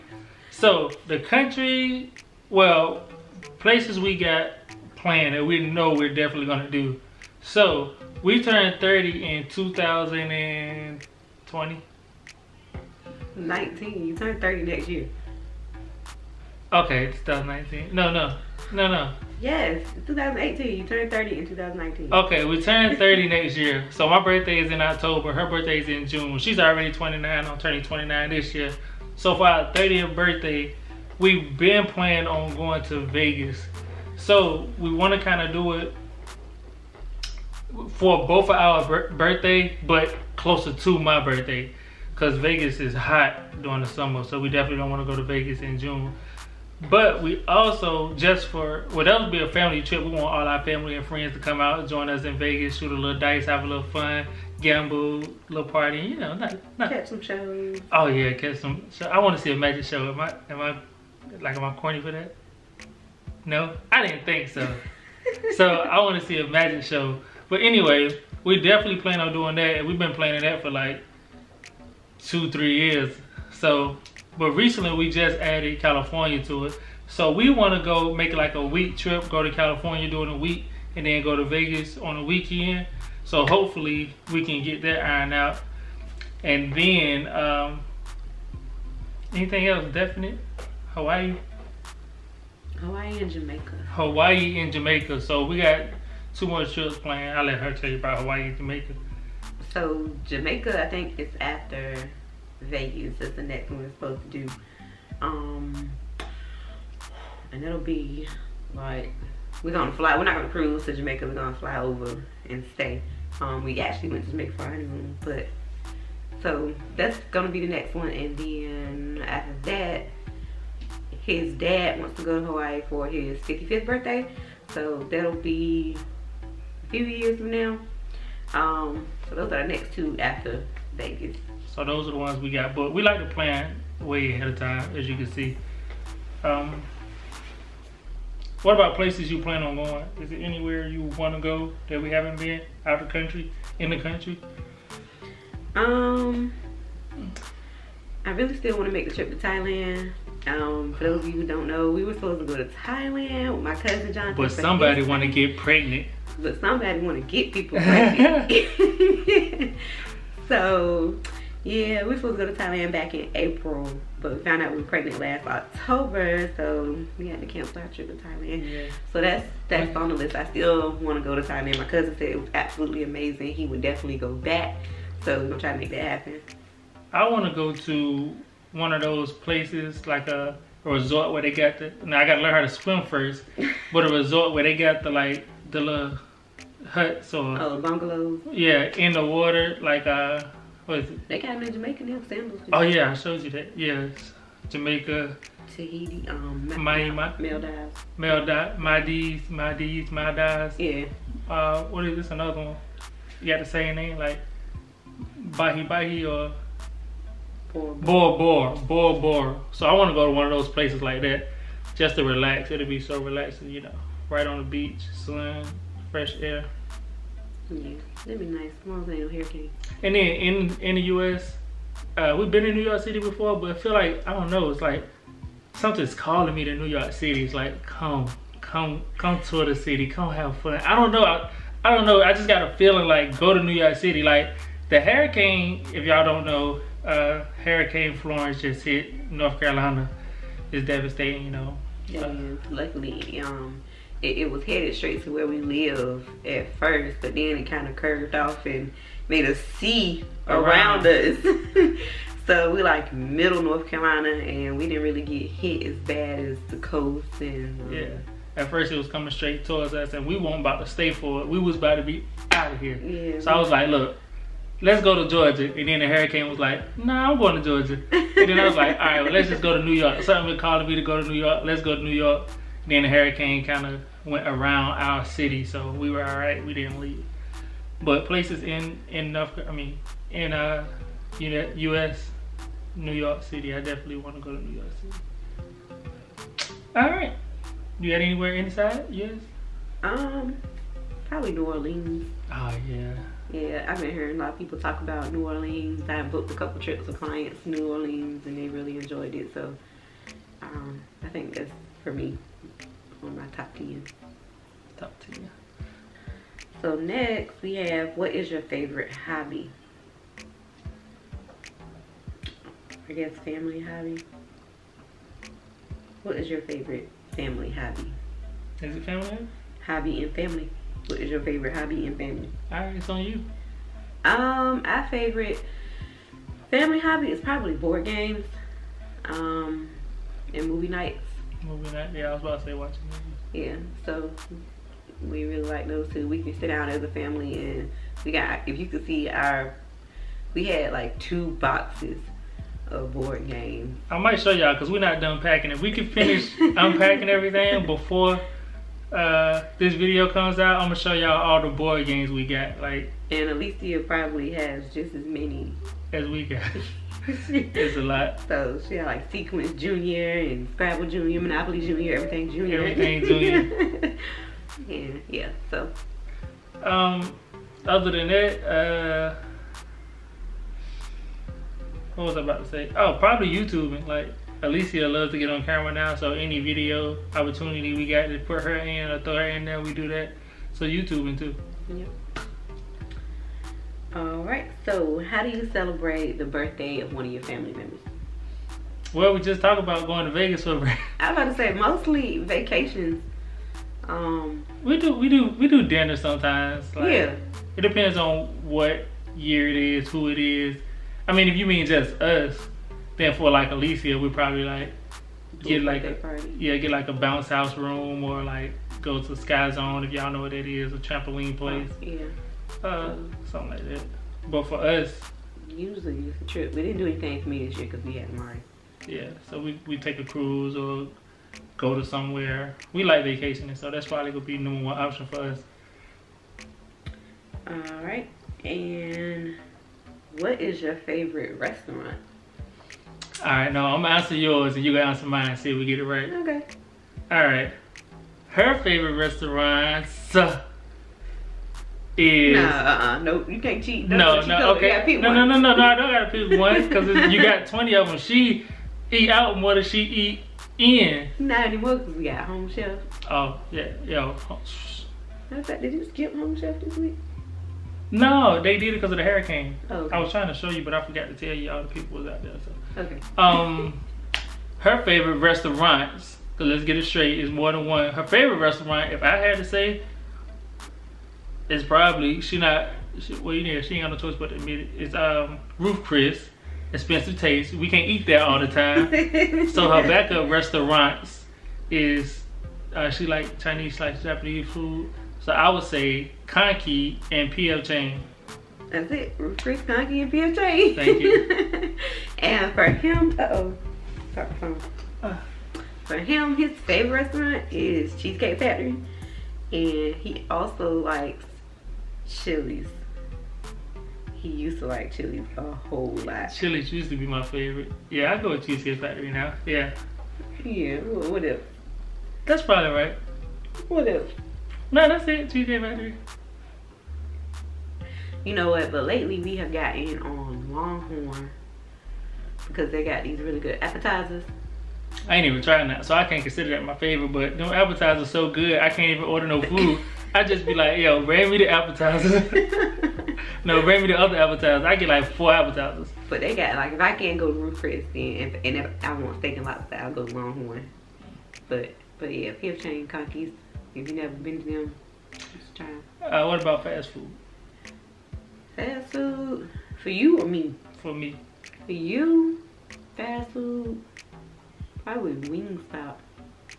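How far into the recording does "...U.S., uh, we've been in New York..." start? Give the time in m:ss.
3:41.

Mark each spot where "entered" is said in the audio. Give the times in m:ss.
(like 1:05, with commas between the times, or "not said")
not said.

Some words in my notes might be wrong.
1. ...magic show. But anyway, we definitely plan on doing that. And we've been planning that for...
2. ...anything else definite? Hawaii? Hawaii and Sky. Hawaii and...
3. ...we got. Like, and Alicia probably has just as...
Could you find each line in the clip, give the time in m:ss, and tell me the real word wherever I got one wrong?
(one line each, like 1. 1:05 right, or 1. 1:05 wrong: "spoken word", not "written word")
1. 1:06 right
2. 1:29 wrong: "Jamaica", not "Sky"
3. 5:52 right.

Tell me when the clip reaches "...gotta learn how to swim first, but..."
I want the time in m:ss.
3:02.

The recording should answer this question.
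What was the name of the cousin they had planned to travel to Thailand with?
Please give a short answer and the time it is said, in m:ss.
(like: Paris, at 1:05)
John, at 2:33.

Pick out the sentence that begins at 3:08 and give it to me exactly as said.
Yeah, in the water, like uh, what is it?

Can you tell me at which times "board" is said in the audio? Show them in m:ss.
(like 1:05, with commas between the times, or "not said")
5:27, 5:43, 5:51.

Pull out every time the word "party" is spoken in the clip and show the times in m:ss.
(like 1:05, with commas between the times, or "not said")
0:55, 6:46.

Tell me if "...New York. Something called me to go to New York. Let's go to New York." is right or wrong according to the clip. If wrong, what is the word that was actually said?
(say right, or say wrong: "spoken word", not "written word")
right.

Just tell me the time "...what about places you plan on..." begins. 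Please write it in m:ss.
2:18.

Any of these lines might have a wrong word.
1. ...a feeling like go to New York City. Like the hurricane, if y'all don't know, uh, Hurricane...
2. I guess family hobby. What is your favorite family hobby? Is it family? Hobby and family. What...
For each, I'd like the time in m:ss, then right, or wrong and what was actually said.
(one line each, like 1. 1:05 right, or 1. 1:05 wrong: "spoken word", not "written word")
1. 3:52 right
2. 5:13 right.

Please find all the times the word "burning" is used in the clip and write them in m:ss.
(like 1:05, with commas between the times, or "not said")
not said.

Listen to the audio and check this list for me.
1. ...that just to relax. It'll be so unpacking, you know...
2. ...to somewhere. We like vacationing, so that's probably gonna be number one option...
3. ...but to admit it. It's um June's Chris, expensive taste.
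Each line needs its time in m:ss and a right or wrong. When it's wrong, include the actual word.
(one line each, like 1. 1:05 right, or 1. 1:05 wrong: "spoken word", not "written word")
1. 3:31 wrong: "relaxing", not "unpacking"
2. 7:01 right
3. 7:54 wrong: "Ruth", not "June".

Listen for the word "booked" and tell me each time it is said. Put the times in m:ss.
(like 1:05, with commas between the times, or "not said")
4:56.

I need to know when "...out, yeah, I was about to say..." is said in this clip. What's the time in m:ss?
5:31.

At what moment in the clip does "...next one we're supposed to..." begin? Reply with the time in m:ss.
1:43.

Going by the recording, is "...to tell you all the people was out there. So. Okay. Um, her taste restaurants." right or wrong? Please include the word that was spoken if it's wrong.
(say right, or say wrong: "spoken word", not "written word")
wrong: "favorite", not "taste".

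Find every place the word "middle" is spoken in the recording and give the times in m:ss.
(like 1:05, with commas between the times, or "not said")
4:13.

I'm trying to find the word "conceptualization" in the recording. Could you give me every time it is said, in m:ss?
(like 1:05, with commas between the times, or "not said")
not said.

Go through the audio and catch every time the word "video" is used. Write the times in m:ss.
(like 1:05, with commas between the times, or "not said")
5:49, 6:16.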